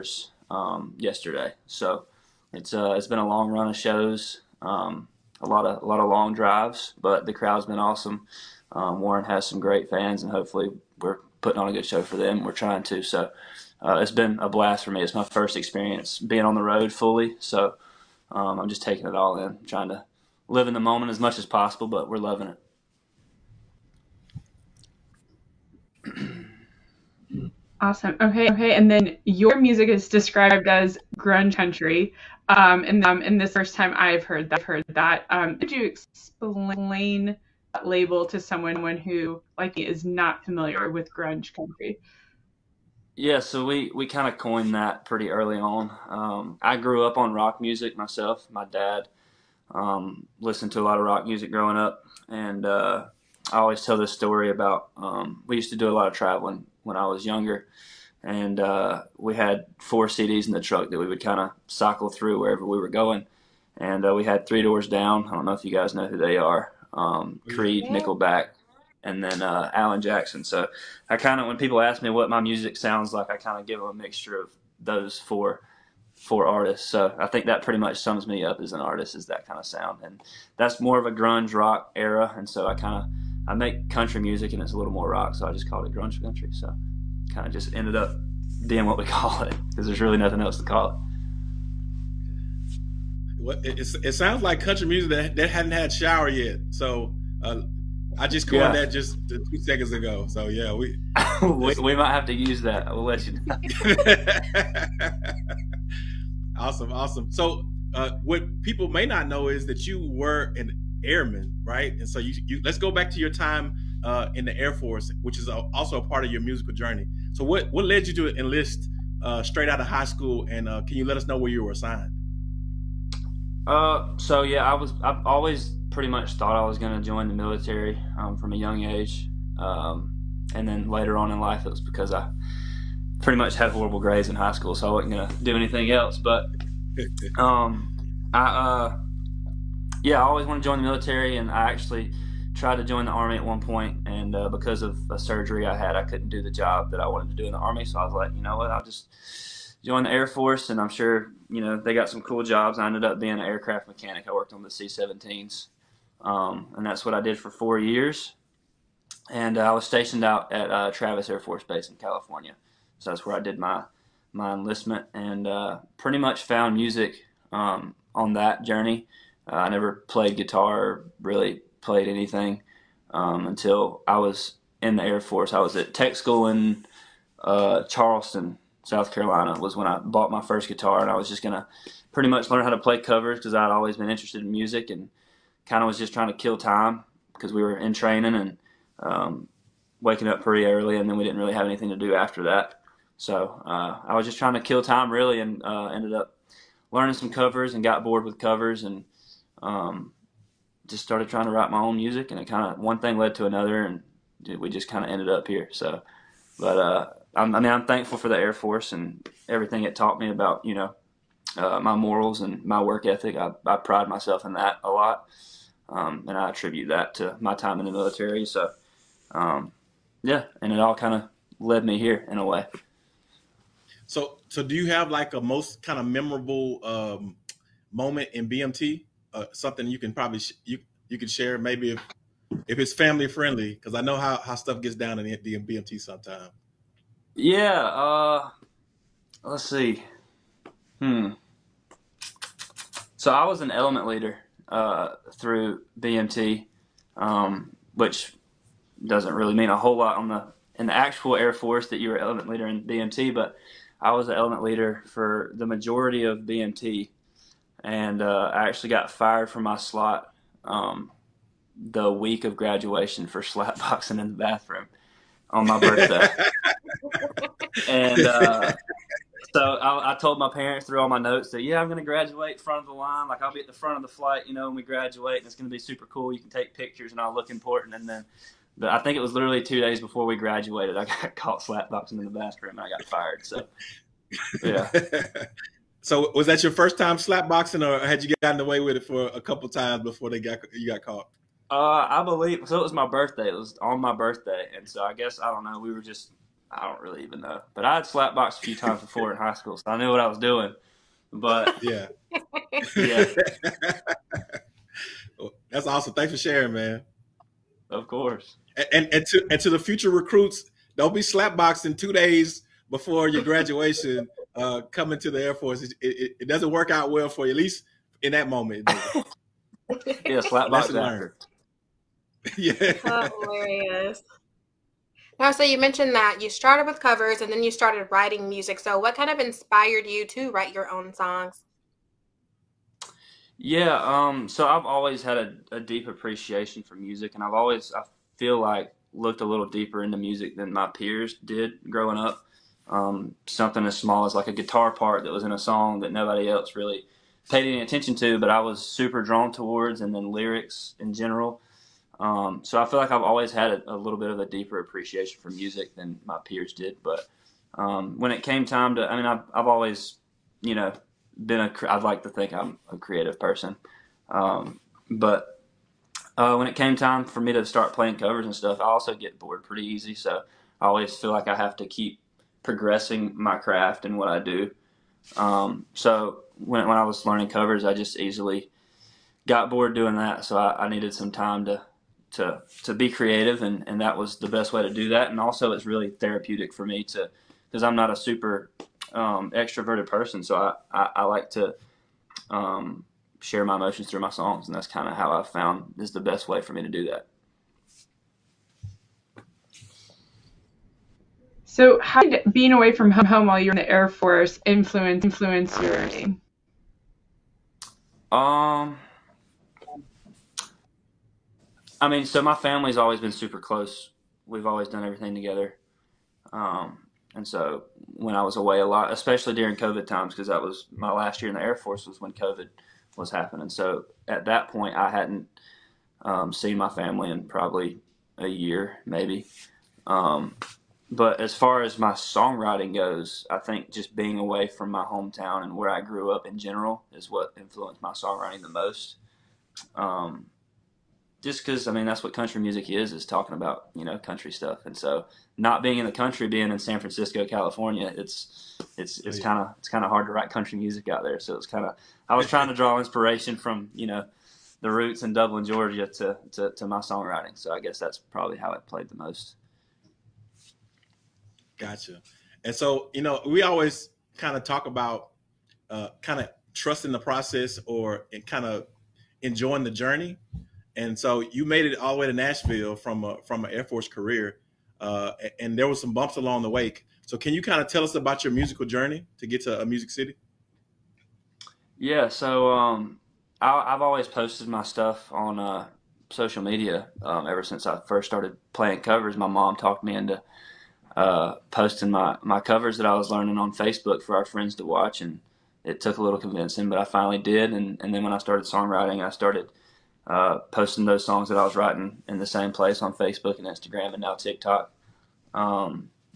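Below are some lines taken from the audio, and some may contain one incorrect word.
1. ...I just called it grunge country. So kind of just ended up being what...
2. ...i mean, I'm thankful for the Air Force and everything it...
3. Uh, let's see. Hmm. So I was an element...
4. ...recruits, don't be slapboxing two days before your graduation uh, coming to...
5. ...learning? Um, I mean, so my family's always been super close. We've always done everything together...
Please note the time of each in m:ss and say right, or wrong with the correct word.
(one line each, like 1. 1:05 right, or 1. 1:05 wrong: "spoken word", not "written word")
1. 1:25 right
2. 3:27 right
3. 3:57 right
4. 5:10 right
5. 6:45 right.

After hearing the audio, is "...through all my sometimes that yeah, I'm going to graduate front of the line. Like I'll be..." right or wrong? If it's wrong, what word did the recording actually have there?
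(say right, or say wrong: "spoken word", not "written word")
wrong: "notes", not "sometimes".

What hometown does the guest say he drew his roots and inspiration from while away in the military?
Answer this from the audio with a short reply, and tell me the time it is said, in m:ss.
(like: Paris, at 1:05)
Dublin, Georgia, at 7:35.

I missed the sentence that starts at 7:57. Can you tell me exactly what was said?
So can you kind of tell us about your musical journey to get to a uh, Music City?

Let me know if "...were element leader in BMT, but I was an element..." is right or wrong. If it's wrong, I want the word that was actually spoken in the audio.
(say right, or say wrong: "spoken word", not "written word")
right.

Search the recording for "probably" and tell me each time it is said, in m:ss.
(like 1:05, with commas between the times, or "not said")
3:50, 7:07, 7:38.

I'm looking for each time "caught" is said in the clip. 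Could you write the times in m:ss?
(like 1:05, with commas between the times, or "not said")
4:41, 4:51.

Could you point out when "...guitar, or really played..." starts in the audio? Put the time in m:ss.
2:50.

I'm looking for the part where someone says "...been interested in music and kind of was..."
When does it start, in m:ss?
3:03.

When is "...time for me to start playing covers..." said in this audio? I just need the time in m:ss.
6:06.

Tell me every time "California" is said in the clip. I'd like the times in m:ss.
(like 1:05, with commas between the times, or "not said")
2:41, 7:27.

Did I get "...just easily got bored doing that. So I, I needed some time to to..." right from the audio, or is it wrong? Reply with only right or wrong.
right.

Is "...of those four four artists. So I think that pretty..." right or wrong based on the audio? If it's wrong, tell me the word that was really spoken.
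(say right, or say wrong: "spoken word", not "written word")
right.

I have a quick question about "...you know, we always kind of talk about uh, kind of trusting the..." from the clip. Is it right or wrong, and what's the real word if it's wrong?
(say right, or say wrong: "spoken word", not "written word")
right.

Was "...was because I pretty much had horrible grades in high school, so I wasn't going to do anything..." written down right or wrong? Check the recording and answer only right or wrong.
right.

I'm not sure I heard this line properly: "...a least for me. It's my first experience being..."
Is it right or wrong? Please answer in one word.
wrong.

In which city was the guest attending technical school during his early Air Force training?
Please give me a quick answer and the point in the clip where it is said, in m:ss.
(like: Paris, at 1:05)
Charleston, South Carolina, at 2:57.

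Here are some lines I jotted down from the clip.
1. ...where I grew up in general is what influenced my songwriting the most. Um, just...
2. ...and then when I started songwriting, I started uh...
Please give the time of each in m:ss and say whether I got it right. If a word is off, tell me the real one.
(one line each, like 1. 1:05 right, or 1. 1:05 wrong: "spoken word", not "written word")
1. 7:15 right
2. 8:18 right.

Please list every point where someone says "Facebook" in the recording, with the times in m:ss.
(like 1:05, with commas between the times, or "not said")
8:13, 8:23.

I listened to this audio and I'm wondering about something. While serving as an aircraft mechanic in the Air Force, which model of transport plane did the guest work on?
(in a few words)
C-17.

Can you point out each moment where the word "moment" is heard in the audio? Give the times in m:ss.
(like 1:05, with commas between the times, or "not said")
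0:20, 3:47, 5:18.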